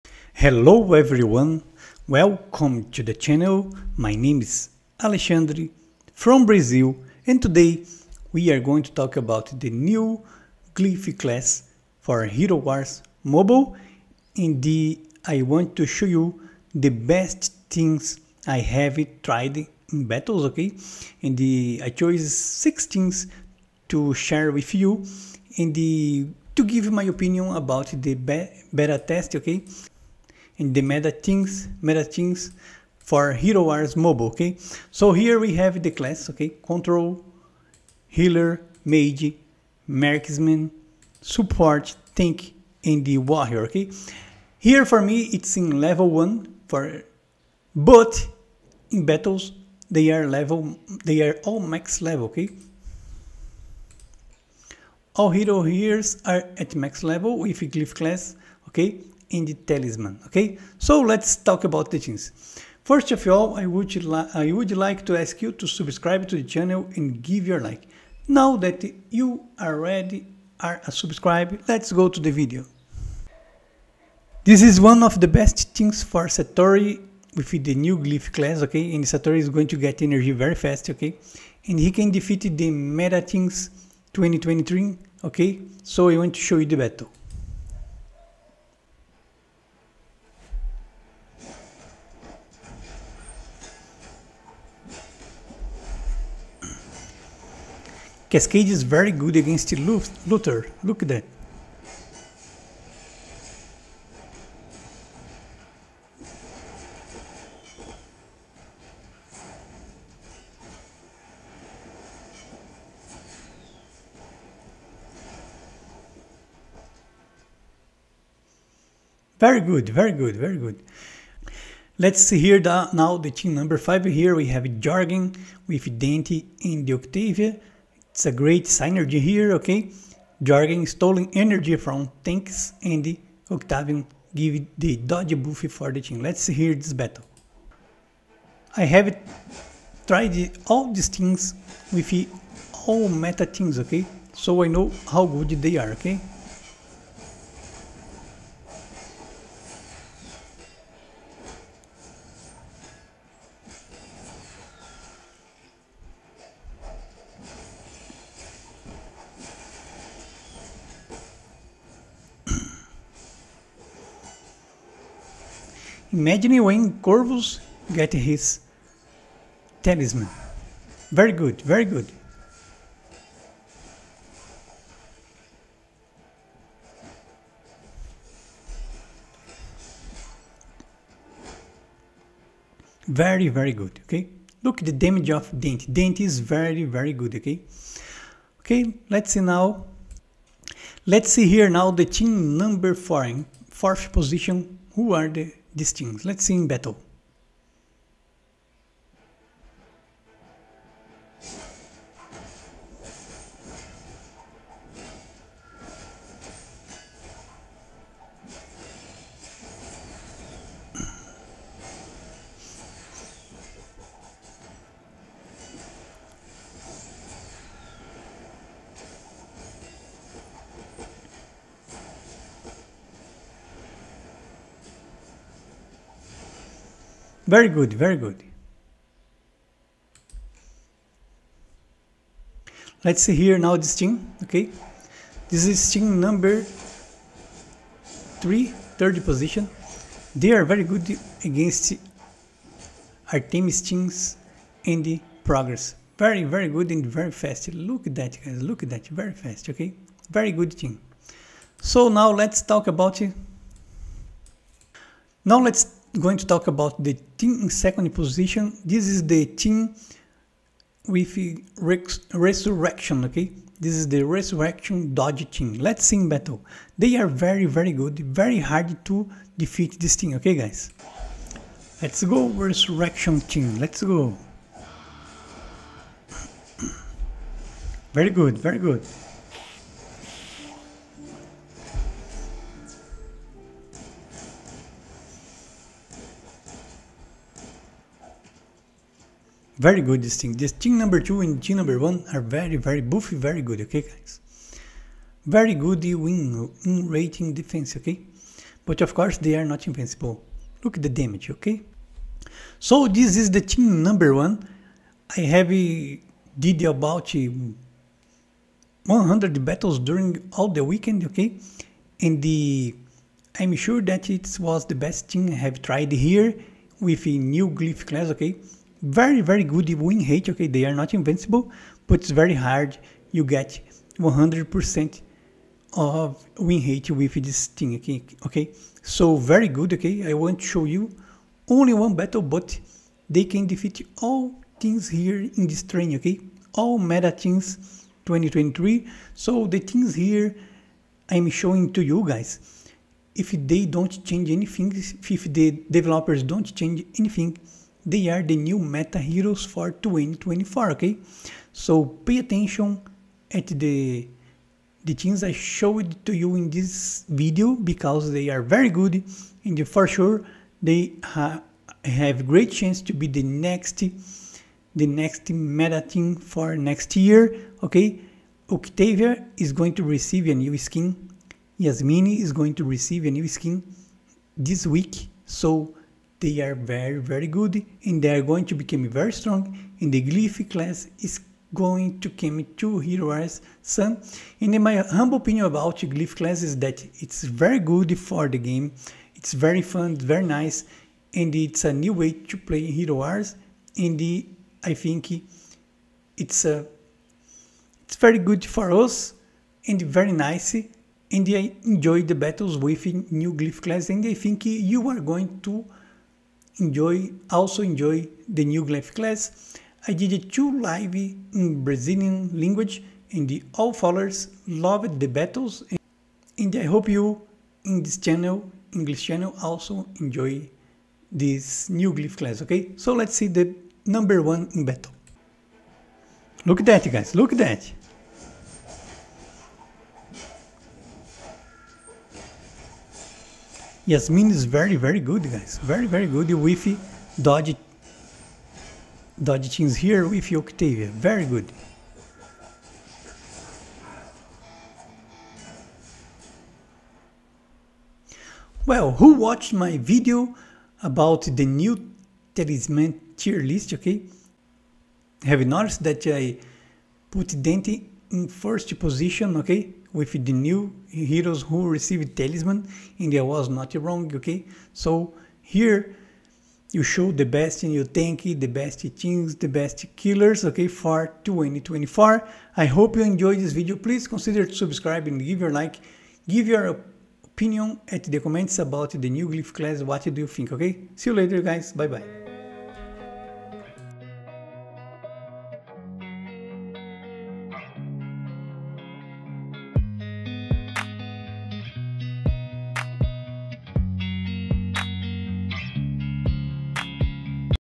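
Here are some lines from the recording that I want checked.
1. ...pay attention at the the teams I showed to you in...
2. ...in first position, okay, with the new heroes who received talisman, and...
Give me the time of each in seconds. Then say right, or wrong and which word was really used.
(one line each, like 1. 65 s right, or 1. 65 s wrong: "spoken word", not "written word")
1. 352 s right
2. 458 s right.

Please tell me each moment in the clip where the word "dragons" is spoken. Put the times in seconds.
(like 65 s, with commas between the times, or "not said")
not said.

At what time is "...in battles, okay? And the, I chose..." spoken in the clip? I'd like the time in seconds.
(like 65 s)
19 s.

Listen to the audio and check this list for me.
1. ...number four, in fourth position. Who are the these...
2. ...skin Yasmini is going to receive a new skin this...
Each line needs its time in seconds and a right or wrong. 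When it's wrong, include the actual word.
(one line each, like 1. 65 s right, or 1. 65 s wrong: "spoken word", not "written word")
1. 192 s right
2. 370 s right.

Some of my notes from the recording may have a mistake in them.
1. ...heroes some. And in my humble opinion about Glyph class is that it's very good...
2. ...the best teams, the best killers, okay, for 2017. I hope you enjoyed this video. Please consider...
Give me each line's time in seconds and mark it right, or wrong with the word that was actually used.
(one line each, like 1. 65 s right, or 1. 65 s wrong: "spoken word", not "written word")
1. 382 s right
2. 468 s wrong: "2024", not "2017".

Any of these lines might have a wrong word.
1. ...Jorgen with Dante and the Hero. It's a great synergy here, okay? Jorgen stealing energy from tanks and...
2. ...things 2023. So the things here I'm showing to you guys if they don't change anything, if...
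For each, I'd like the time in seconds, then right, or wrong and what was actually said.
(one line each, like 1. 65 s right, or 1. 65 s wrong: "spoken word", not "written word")
1. 124 s wrong: "Octavia", not "Hero"
2. 337 s right.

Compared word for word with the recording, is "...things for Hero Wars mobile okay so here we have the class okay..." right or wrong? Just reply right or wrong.
right.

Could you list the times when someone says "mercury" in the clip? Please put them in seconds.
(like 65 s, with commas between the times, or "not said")
not said.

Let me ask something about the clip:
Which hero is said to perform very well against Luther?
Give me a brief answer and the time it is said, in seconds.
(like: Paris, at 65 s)
Cascade, at 98 s.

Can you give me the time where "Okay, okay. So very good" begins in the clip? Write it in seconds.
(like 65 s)
327 s.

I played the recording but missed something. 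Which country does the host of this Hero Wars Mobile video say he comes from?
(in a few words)
Brazil.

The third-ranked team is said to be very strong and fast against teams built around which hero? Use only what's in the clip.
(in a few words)
Artemis.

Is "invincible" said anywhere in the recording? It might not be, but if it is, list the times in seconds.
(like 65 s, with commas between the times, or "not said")
299 s, 321 s.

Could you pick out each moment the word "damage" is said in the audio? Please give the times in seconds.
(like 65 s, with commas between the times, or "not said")
184 s, 301 s.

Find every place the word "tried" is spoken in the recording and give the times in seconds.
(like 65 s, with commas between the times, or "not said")
19 s, 140 s, 315 s.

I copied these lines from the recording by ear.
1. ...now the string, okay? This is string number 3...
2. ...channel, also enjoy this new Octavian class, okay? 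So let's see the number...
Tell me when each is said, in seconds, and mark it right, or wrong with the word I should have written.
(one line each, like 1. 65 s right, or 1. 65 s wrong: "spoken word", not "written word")
1. 233 s right
2. 419 s wrong: "Glyph", not "Octavian".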